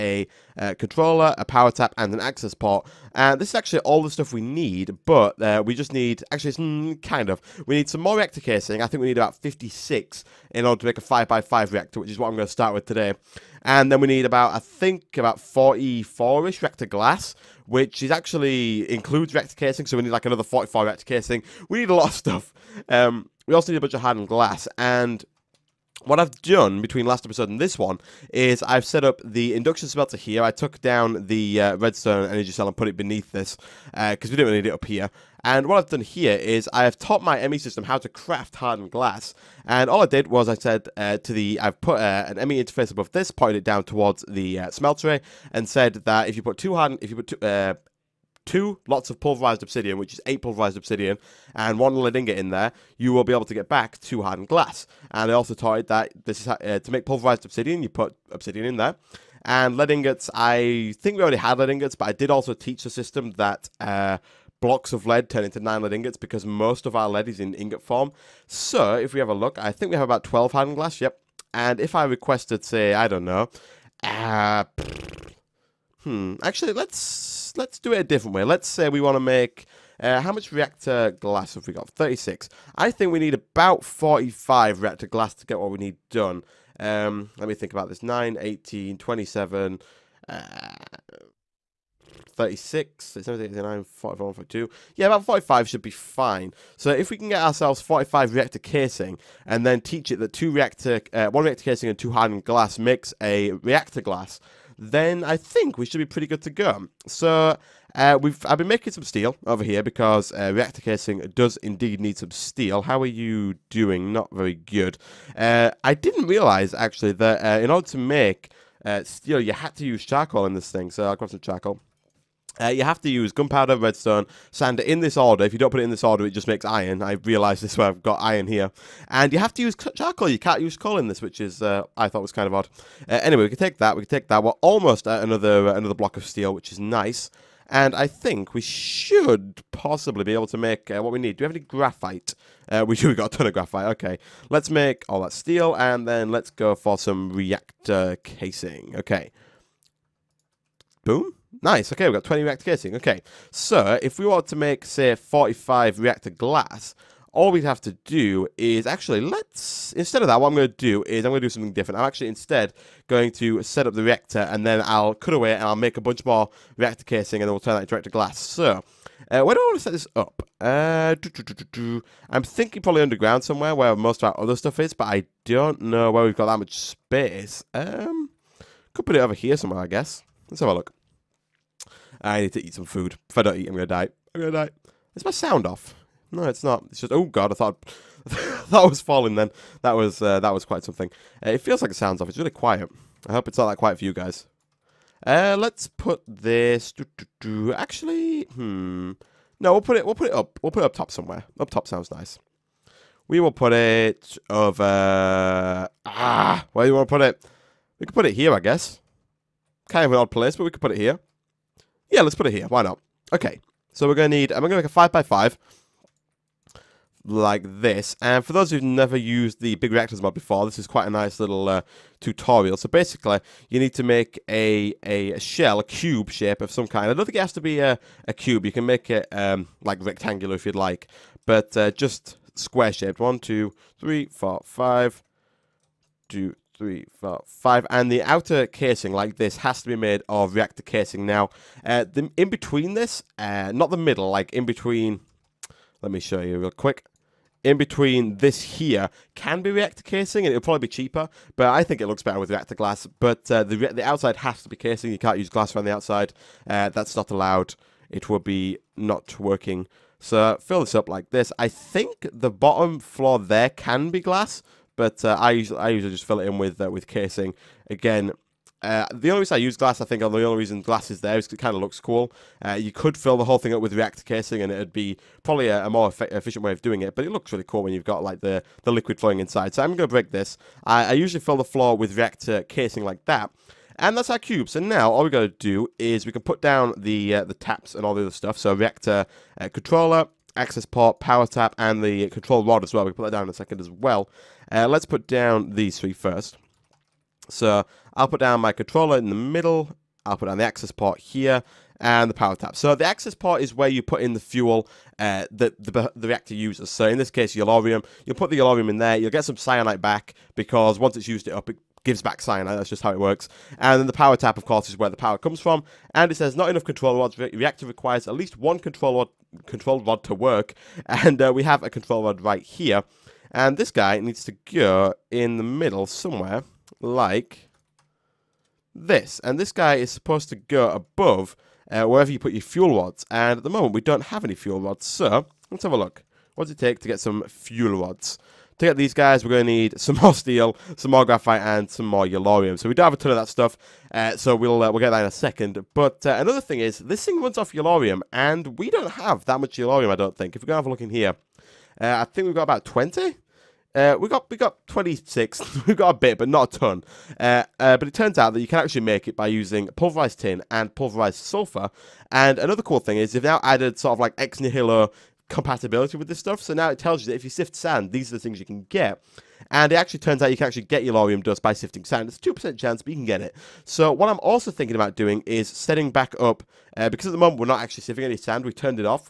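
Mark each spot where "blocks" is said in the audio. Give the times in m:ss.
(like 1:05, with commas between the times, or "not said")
1:04, 2:15.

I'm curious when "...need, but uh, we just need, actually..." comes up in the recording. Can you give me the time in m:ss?
0:04.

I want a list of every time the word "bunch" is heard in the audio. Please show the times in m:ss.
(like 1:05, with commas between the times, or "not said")
0:23, 2:46.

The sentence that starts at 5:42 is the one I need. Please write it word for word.
So we don't have a ton of that stuff, uh, so we'll uh, we'll get that in a second.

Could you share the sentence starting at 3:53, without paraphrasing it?
One, two, three, four, five, two, three, four, five.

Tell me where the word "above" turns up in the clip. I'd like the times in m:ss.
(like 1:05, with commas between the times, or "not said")
0:42, 5:30.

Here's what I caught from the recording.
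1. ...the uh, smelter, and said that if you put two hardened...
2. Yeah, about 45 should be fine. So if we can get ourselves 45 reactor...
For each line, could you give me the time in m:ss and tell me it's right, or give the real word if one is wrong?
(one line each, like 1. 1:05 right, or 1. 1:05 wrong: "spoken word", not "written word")
1. 0:44 right
2. 1:34 right.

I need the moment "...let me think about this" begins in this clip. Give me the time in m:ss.
1:27.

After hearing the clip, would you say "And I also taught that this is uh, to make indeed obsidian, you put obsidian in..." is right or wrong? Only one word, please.
wrong.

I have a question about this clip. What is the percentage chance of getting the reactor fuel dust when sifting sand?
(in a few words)
2%.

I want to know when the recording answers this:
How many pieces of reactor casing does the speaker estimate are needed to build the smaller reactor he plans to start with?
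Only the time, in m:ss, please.
0:09.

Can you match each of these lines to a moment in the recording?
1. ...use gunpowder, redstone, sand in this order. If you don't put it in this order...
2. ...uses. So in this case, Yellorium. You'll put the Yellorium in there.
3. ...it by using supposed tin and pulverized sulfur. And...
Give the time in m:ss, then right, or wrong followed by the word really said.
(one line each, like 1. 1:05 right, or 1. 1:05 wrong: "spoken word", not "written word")
1. 2:03 right
2. 5:06 right
3. 5:59 wrong: "pulverized", not "supposed".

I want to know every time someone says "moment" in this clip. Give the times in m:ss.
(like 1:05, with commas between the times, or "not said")
5:33, 6:17.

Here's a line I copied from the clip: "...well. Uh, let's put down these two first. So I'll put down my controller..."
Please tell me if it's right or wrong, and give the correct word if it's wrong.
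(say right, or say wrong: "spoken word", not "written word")
wrong: "three", not "two".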